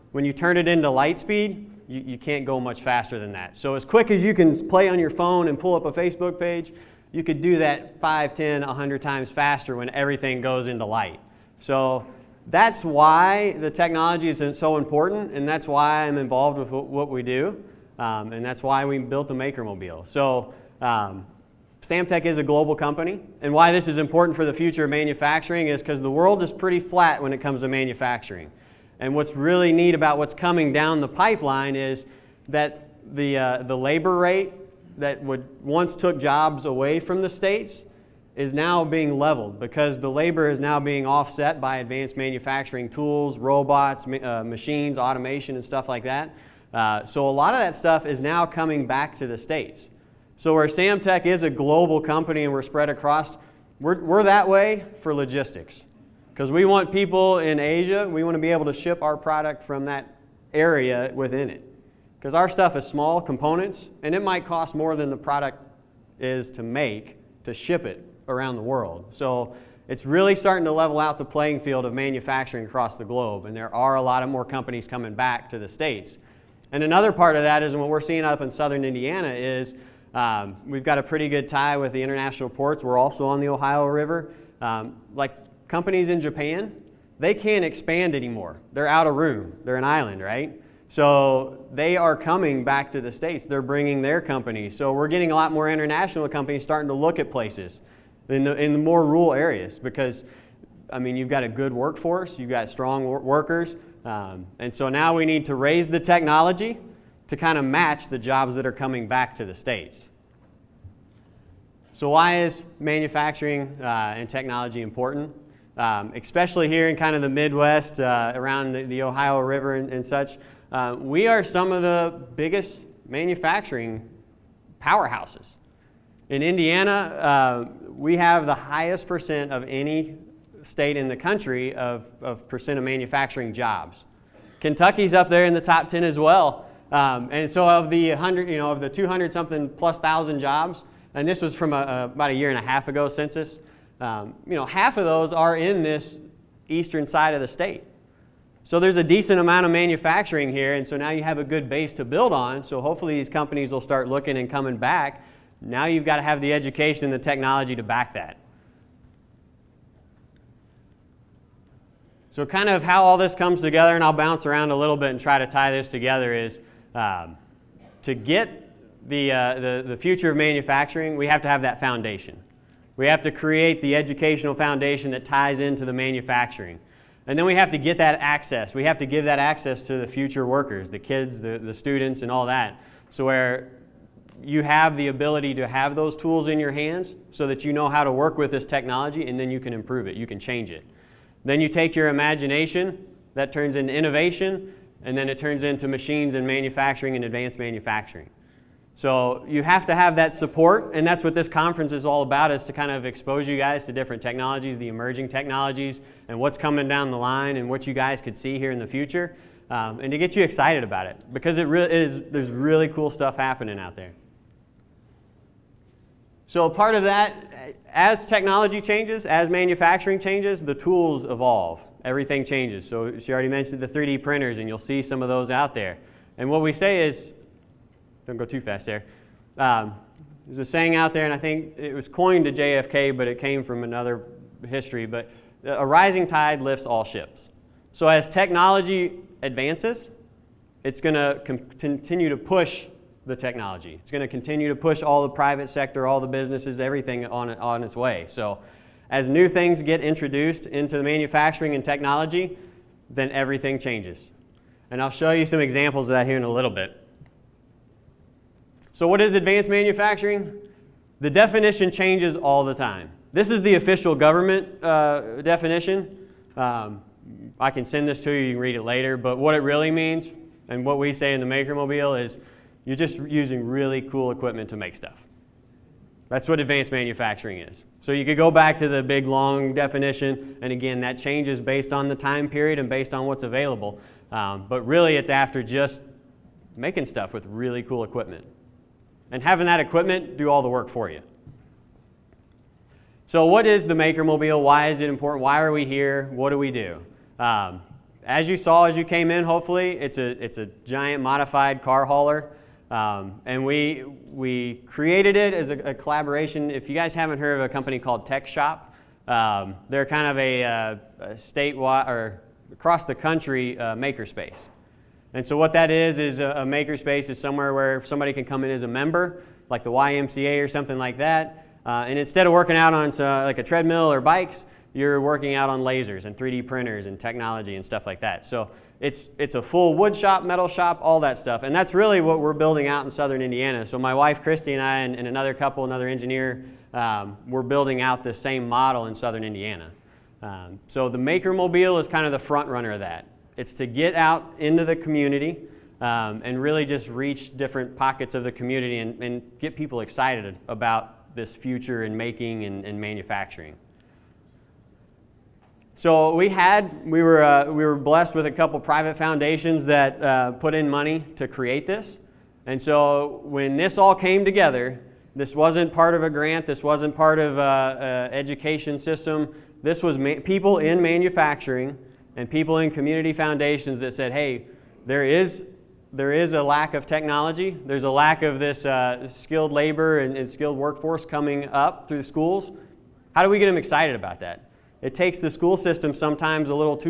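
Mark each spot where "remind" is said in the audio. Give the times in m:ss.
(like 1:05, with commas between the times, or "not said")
not said.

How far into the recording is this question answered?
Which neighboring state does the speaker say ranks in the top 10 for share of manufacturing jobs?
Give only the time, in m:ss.
2:14.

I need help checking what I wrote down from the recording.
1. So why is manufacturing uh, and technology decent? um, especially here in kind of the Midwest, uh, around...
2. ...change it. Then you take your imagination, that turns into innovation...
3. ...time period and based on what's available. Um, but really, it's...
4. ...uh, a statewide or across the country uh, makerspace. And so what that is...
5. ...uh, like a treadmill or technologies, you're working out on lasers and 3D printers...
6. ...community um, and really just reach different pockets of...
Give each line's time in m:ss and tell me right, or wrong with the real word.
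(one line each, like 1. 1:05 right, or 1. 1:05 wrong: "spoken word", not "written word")
1. 1:51 wrong: "important", not "decent"
2. 3:10 right
3. 4:42 right
4. 5:10 right
5. 5:23 wrong: "bikes", not "technologies"
6. 5:44 right.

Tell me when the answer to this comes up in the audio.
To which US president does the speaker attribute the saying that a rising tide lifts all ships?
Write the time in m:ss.
3:52.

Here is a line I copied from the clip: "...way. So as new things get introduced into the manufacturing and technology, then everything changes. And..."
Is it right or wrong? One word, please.
right.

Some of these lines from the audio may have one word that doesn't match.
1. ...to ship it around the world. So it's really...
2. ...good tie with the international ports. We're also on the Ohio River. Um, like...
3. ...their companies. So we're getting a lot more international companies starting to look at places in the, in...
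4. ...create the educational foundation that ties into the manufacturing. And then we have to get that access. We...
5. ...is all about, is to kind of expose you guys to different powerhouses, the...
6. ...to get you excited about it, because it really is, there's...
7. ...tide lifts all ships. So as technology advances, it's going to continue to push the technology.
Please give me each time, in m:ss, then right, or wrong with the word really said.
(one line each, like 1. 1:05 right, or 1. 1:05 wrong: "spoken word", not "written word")
1. 1:07 right
2. 1:21 right
3. 1:34 right
4. 2:53 right
5. 3:21 wrong: "technologies", not "powerhouses"
6. 3:30 right
7. 3:56 right.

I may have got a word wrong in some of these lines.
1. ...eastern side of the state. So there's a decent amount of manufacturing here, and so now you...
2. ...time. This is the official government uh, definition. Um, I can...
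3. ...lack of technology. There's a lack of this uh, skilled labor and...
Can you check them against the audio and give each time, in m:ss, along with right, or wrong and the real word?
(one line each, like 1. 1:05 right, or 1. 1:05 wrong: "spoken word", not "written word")
1. 2:26 right
2. 4:22 right
3. 6:16 right.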